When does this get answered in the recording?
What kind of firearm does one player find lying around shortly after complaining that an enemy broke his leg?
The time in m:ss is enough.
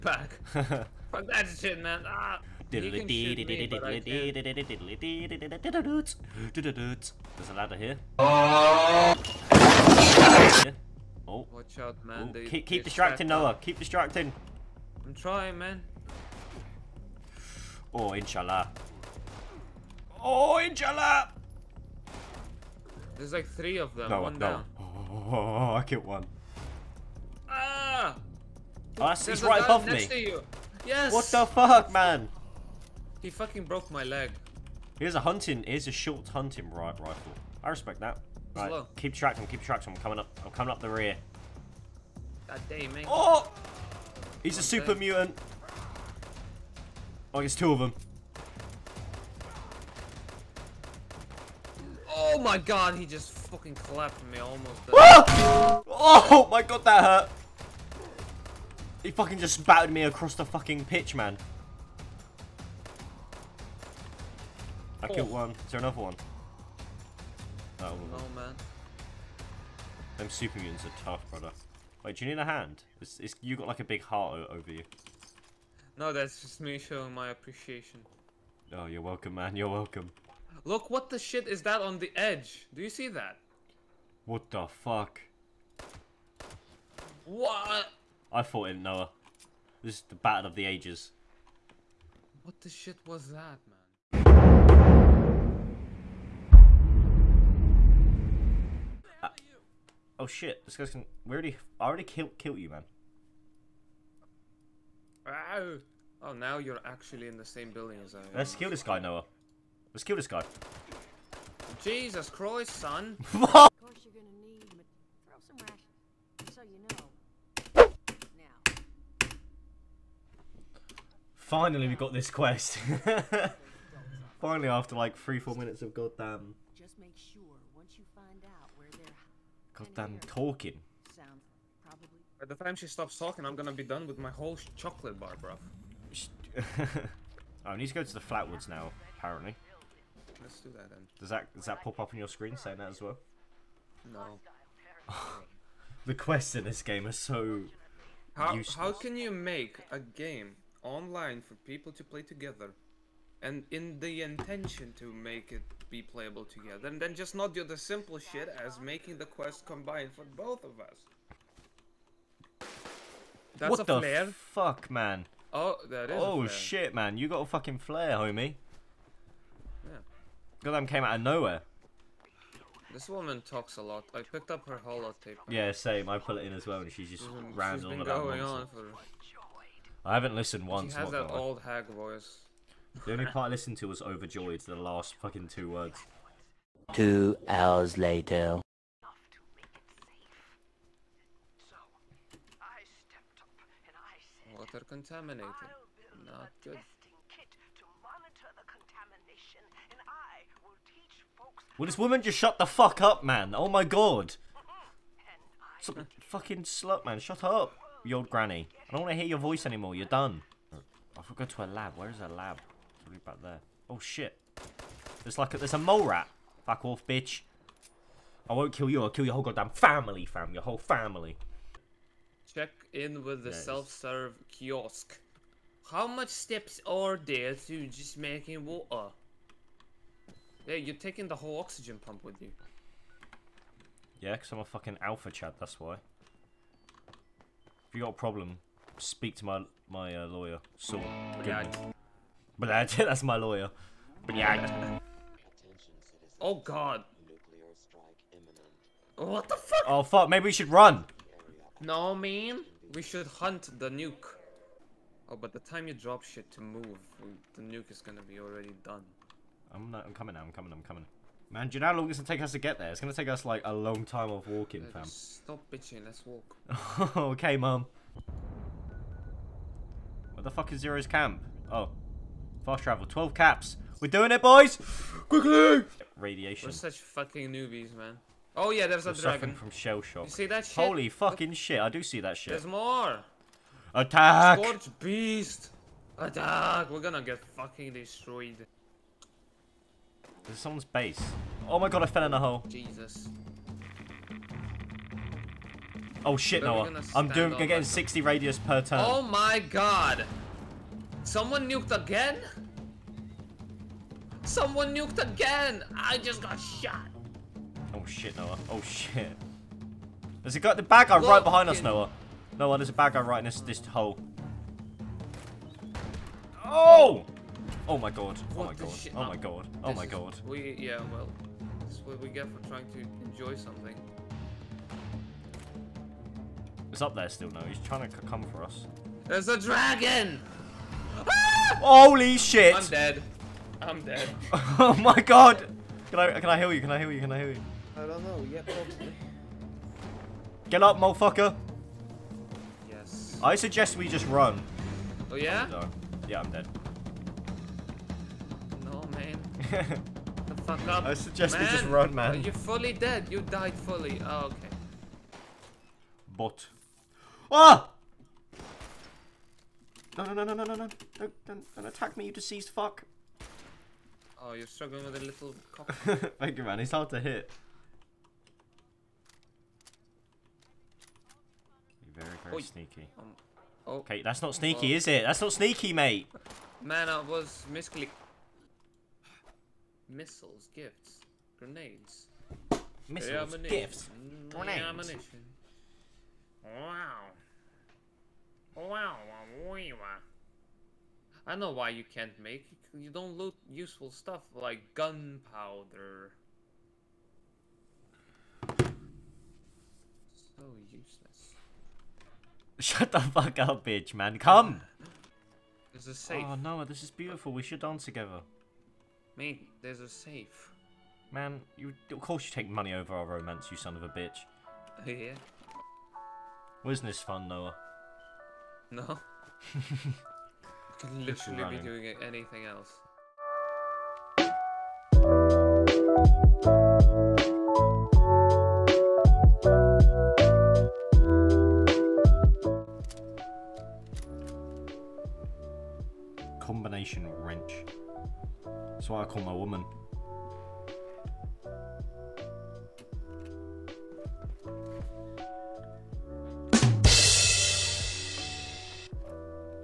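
0:35.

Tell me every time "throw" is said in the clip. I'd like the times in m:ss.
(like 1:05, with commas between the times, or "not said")
1:55.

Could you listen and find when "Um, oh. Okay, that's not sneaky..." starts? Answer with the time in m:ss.
6:13.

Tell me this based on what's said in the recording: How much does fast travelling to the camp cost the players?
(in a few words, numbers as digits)
12 caps.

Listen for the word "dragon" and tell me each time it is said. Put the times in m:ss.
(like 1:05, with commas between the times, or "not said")
4:39, 5:29.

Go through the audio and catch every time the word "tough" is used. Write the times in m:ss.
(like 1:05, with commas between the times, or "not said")
1:11.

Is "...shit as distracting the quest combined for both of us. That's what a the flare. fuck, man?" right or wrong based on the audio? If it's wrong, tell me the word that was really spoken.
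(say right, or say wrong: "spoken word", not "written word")
wrong: "making", not "distracting".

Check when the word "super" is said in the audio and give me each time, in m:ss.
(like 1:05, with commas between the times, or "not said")
0:44, 1:10.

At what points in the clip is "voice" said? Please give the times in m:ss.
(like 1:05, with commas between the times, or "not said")
3:01, 3:29.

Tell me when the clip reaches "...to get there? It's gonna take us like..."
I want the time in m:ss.
4:22.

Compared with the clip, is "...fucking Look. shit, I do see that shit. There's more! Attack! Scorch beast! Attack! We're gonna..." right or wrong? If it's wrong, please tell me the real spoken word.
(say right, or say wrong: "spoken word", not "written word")
right.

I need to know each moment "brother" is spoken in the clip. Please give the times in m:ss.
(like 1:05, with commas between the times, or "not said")
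1:11.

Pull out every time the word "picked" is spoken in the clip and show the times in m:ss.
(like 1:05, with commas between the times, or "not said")
2:54.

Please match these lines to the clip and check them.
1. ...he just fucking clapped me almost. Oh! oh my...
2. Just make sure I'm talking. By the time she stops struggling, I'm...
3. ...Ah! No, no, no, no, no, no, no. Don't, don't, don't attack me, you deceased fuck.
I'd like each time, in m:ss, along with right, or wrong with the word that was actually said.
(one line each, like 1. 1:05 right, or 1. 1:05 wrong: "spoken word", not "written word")
1. 0:52 right
2. 2:06 wrong: "talking", not "struggling"
3. 5:57 right.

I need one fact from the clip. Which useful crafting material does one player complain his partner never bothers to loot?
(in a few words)
Gunpowder.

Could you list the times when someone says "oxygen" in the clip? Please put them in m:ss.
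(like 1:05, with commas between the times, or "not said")
3:51.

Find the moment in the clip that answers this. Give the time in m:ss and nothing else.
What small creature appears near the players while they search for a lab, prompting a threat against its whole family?
3:35.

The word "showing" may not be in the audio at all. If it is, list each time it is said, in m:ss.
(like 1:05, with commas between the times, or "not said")
1:16.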